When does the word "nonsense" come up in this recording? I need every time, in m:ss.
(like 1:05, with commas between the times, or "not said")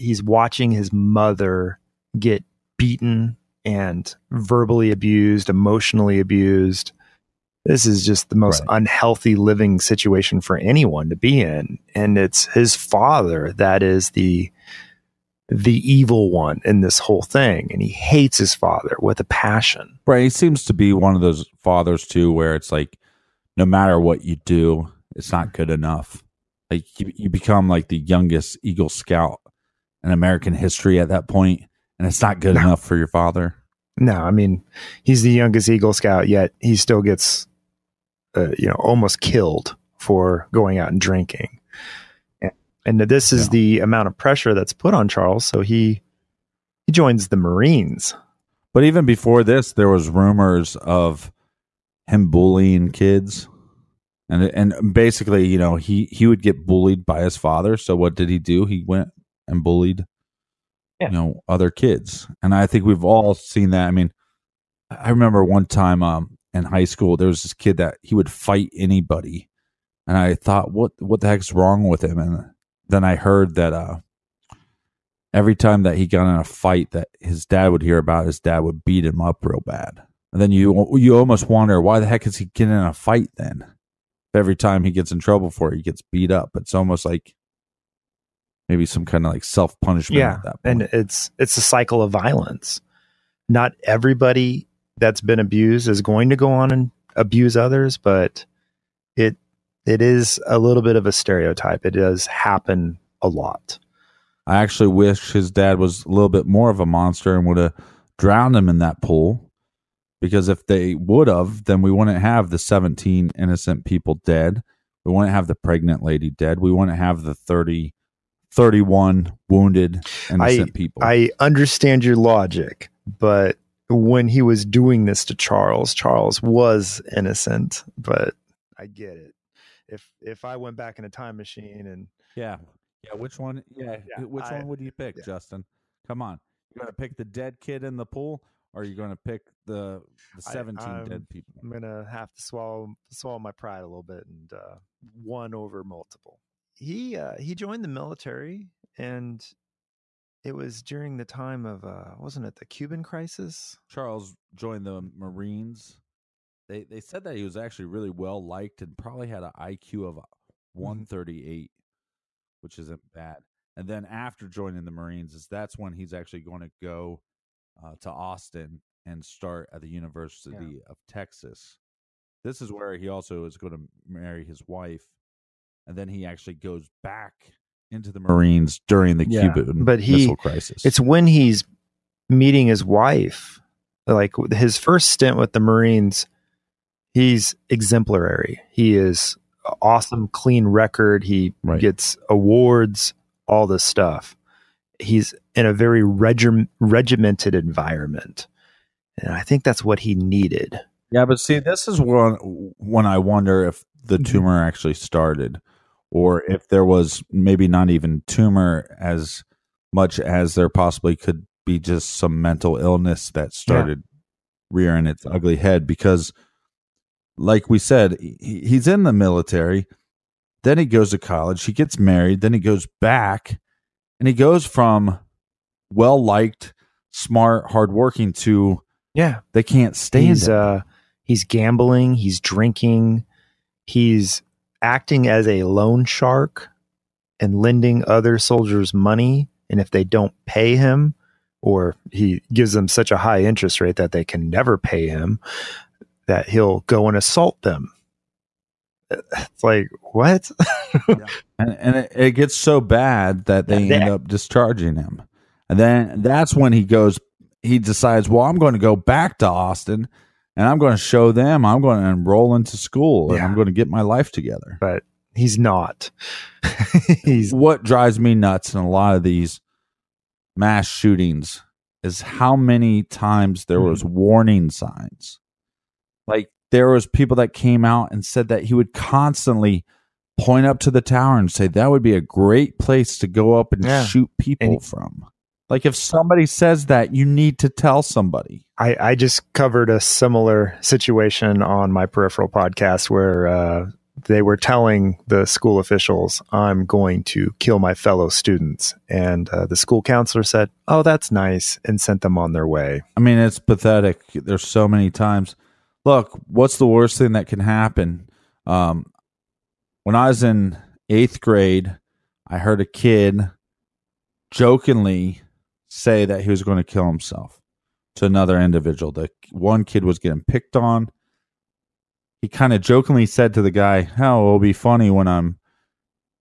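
not said.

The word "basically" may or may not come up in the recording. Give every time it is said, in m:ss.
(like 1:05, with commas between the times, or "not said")
0:54.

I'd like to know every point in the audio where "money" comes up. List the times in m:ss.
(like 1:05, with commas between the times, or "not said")
3:58.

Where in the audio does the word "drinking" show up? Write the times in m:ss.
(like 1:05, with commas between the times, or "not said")
0:40, 3:52.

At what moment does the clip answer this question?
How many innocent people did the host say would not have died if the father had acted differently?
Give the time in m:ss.
1:52.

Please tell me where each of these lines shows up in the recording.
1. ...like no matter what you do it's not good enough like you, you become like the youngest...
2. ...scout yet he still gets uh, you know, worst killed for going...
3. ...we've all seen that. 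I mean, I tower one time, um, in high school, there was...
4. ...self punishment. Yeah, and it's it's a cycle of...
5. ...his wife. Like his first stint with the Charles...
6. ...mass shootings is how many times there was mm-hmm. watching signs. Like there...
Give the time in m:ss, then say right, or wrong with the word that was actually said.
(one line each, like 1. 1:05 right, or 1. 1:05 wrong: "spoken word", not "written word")
1. 0:22 right
2. 0:35 wrong: "almost", not "worst"
3. 1:02 wrong: "remember", not "tower"
4. 1:29 right
5. 3:02 wrong: "Marines", not "Charles"
6. 4:30 wrong: "warning", not "watching".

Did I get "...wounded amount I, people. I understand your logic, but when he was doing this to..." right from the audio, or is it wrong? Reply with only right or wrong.
wrong.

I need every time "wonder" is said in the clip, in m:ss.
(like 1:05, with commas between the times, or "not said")
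1:21, 3:23.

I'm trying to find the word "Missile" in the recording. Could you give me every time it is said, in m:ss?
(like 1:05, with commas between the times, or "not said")
3:00.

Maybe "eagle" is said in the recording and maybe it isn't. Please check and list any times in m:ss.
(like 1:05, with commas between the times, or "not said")
0:28, 0:35.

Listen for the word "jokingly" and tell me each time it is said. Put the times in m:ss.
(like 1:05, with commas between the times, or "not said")
5:14, 5:22.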